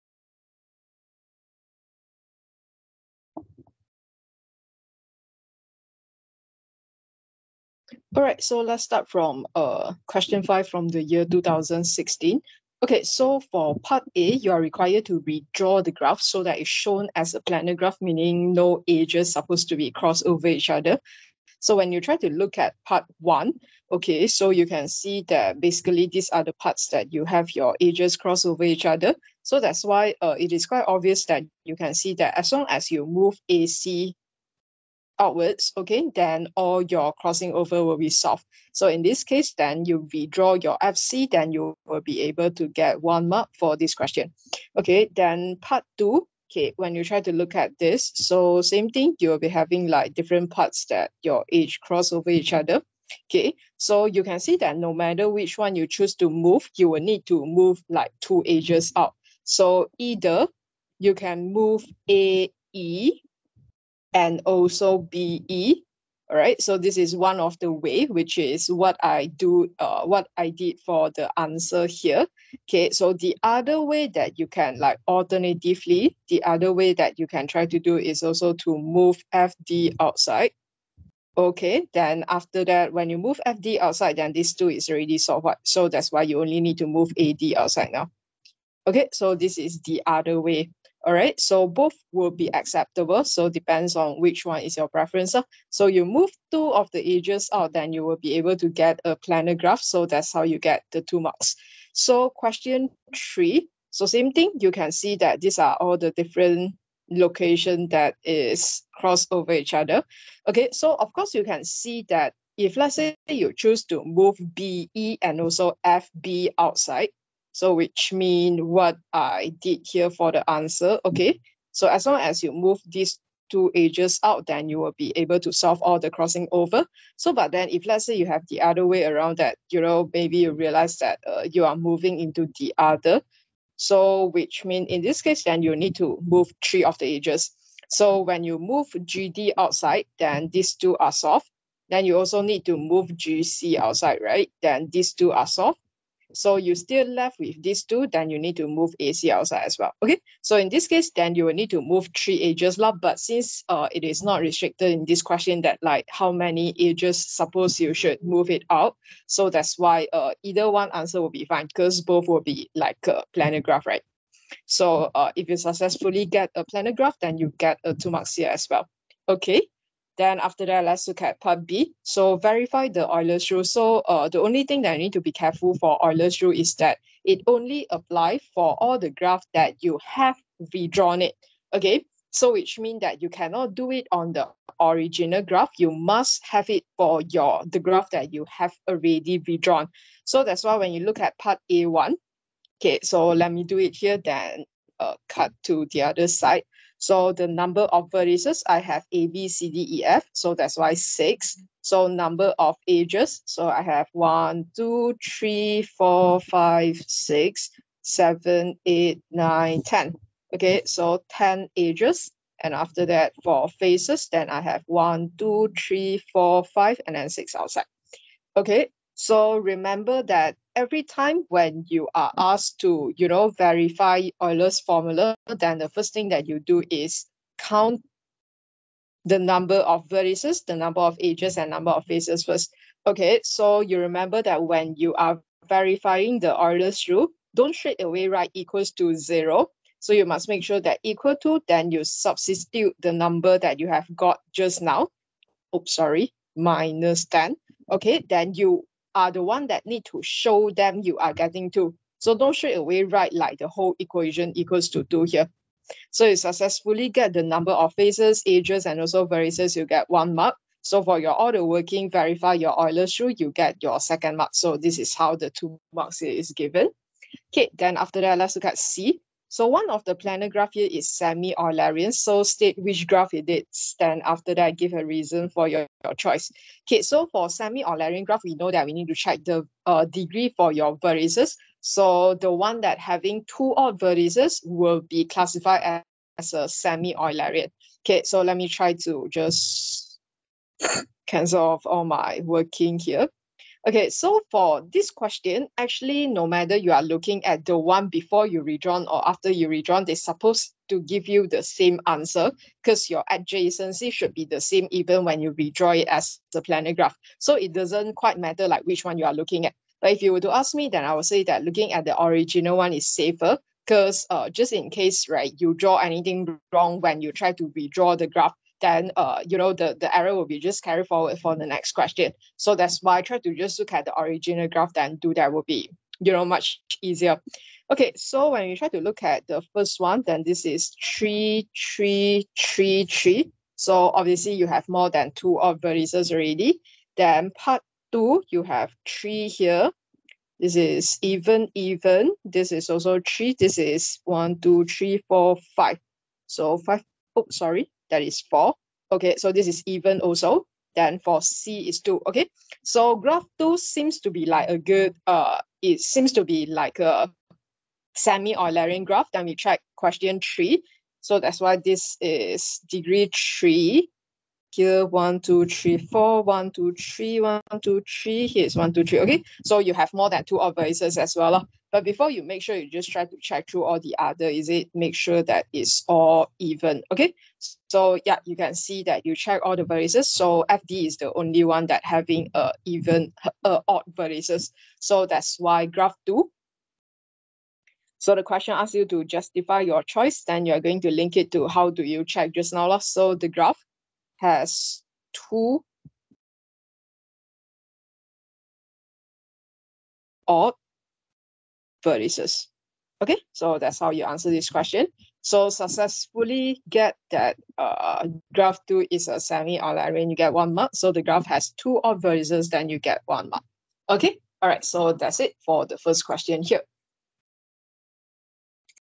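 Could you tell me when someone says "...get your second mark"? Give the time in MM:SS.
04:23.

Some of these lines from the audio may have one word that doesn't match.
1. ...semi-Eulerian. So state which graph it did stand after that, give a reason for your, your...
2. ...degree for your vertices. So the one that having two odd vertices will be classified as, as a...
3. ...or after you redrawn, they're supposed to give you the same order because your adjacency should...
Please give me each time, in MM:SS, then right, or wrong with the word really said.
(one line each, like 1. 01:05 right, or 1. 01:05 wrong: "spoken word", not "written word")
1. 04:31 right
2. 04:40 right
3. 04:59 wrong: "answer", not "order".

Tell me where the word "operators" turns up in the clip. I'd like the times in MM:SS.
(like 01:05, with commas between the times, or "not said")
06:10.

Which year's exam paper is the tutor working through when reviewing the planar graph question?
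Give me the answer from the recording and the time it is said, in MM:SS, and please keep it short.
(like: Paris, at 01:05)
2016, at 00:11.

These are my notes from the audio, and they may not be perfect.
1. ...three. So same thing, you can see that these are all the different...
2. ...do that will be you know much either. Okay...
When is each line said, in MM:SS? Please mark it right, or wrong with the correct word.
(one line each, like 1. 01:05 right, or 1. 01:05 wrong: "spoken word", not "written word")
1. 01:43 right
2. 05:25 wrong: "easier", not "either".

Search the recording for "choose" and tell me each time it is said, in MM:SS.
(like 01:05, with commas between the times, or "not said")
00:55, 01:53.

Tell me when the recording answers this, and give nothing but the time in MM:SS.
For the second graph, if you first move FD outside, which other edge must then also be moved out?
01:27.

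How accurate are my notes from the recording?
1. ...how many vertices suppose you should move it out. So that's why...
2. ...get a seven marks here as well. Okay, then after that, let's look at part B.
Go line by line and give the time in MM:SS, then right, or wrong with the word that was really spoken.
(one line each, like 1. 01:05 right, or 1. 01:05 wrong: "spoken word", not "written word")
1. 02:36 wrong: "edges", not "vertices"
2. 02:47 wrong: "two", not "seven".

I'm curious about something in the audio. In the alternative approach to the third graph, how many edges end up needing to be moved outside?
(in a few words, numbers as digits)
3.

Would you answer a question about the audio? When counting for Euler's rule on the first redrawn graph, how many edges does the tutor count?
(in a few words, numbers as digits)
10.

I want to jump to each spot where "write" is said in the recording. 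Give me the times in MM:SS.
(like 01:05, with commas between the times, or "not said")
03:58, 04:13.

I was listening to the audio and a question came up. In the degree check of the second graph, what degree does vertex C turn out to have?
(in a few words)
2.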